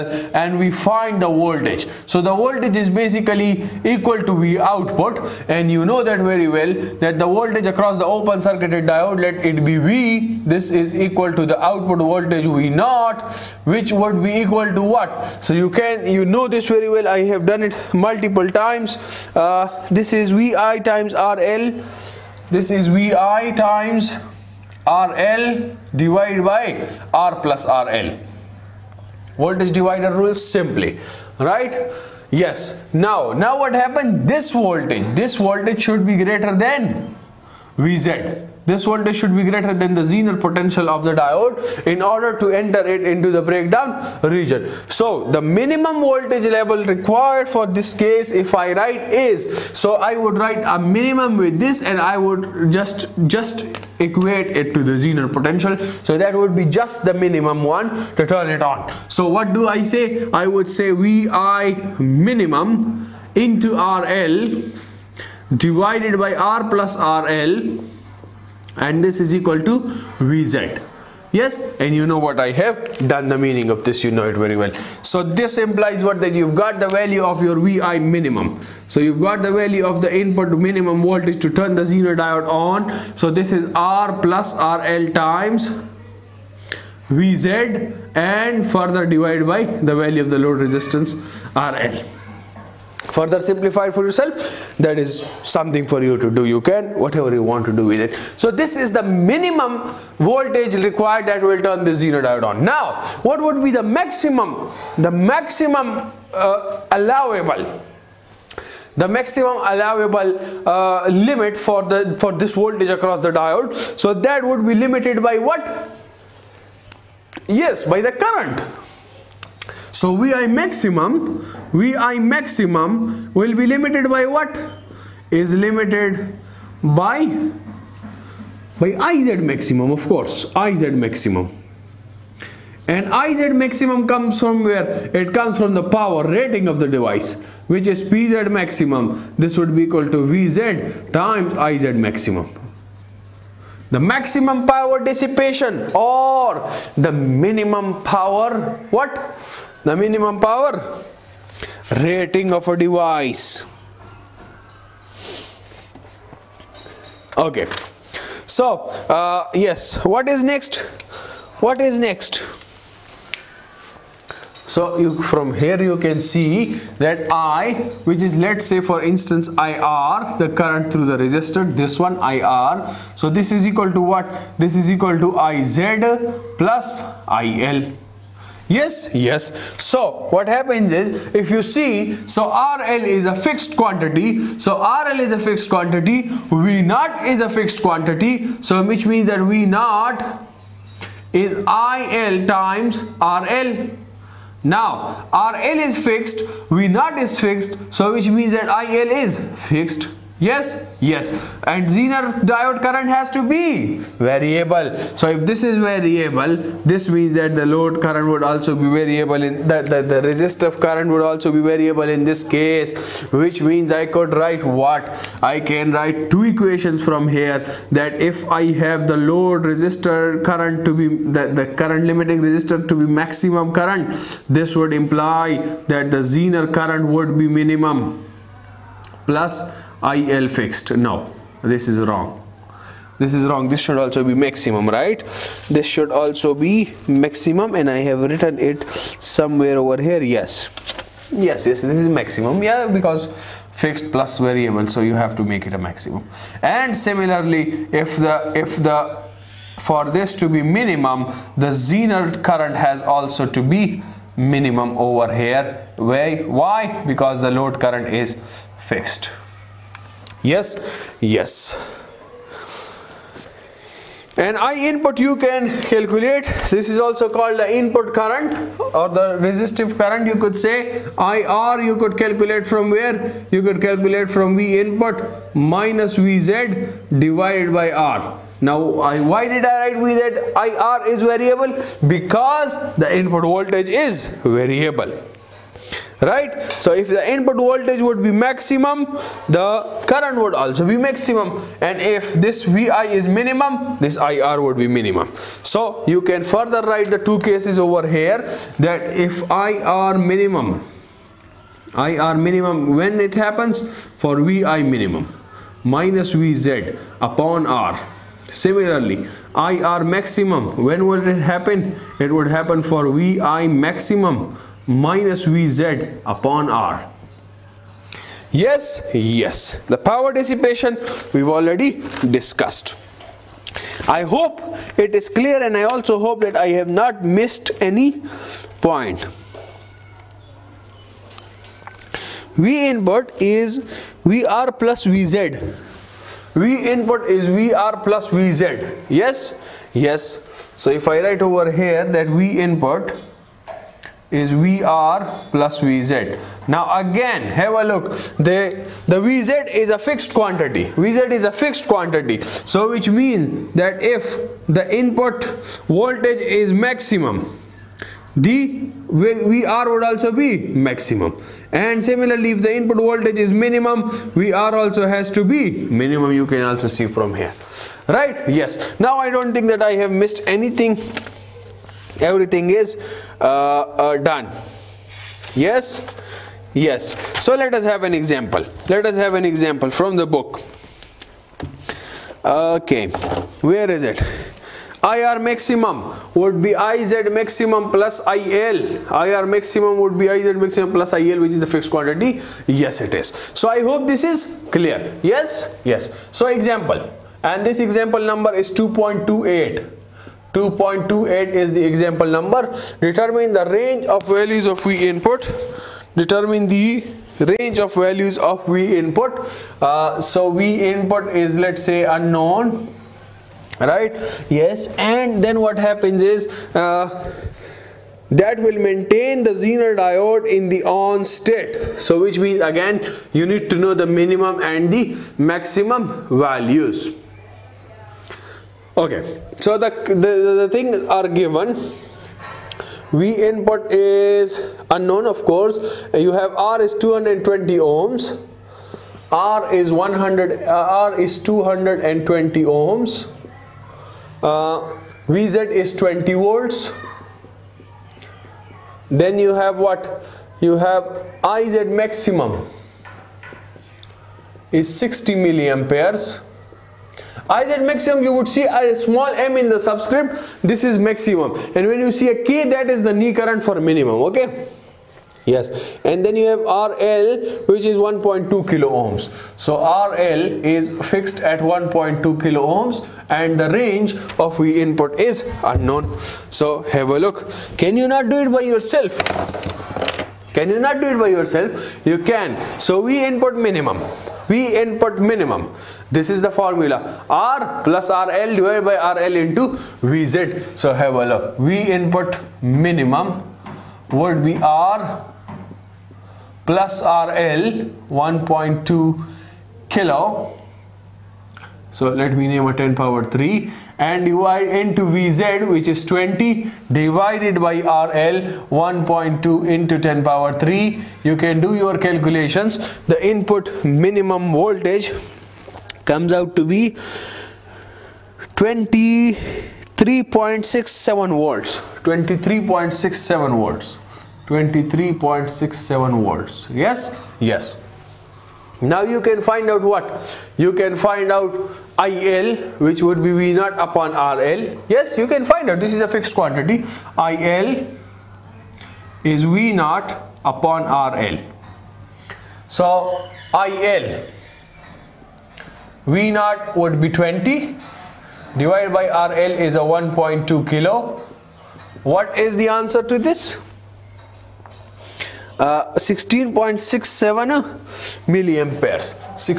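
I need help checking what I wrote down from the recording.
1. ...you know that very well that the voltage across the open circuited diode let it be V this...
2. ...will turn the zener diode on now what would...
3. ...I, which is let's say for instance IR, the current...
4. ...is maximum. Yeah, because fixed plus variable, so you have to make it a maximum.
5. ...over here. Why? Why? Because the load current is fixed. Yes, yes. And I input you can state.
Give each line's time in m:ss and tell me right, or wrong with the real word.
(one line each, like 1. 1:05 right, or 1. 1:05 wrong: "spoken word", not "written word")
1. 0:05 right
2. 1:41 right
3. 2:47 right
4. 4:01 right
5. 4:14 wrong: "calculate", not "state".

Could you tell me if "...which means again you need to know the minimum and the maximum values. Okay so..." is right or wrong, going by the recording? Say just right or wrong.
right.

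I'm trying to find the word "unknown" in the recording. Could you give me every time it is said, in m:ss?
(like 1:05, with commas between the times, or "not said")
6:52, 7:14, 7:55.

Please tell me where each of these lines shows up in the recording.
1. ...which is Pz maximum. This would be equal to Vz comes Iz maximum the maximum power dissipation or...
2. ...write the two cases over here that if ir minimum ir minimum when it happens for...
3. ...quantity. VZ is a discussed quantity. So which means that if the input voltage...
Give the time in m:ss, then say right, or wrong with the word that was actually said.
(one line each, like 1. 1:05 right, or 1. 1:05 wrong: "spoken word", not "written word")
1. 2:17 wrong: "times", not "comes"
2. 4:56 right
3. 5:50 wrong: "fixed", not "discussed".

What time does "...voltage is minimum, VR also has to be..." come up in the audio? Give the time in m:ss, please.
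6:02.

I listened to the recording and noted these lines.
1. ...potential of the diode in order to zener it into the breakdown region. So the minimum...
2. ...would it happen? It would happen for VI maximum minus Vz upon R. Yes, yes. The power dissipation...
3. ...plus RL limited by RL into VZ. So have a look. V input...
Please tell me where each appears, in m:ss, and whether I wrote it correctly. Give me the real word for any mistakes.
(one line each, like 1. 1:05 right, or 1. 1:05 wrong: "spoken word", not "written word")
1. 0:40 wrong: "enter", not "zener"
2. 5:11 right
3. 8:07 wrong: "divided", not "limited".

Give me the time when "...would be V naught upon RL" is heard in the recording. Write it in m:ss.
8:53.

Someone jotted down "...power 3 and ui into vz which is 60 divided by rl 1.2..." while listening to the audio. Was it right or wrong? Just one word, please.
wrong.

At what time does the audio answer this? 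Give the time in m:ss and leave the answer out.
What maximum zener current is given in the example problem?
7:34.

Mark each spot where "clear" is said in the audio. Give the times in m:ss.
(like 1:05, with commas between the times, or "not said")
5:25, 6:34.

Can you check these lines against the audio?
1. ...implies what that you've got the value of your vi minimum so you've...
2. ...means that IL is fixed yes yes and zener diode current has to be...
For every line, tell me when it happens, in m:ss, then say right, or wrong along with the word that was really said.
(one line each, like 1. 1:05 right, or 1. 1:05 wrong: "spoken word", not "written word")
1. 1:15 right
2. 3:18 right.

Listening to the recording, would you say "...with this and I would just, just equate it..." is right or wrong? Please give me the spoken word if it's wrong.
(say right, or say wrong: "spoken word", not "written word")
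right.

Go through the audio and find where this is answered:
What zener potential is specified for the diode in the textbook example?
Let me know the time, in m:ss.
7:25.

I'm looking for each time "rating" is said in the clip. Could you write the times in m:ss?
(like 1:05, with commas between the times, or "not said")
2:16, 2:32.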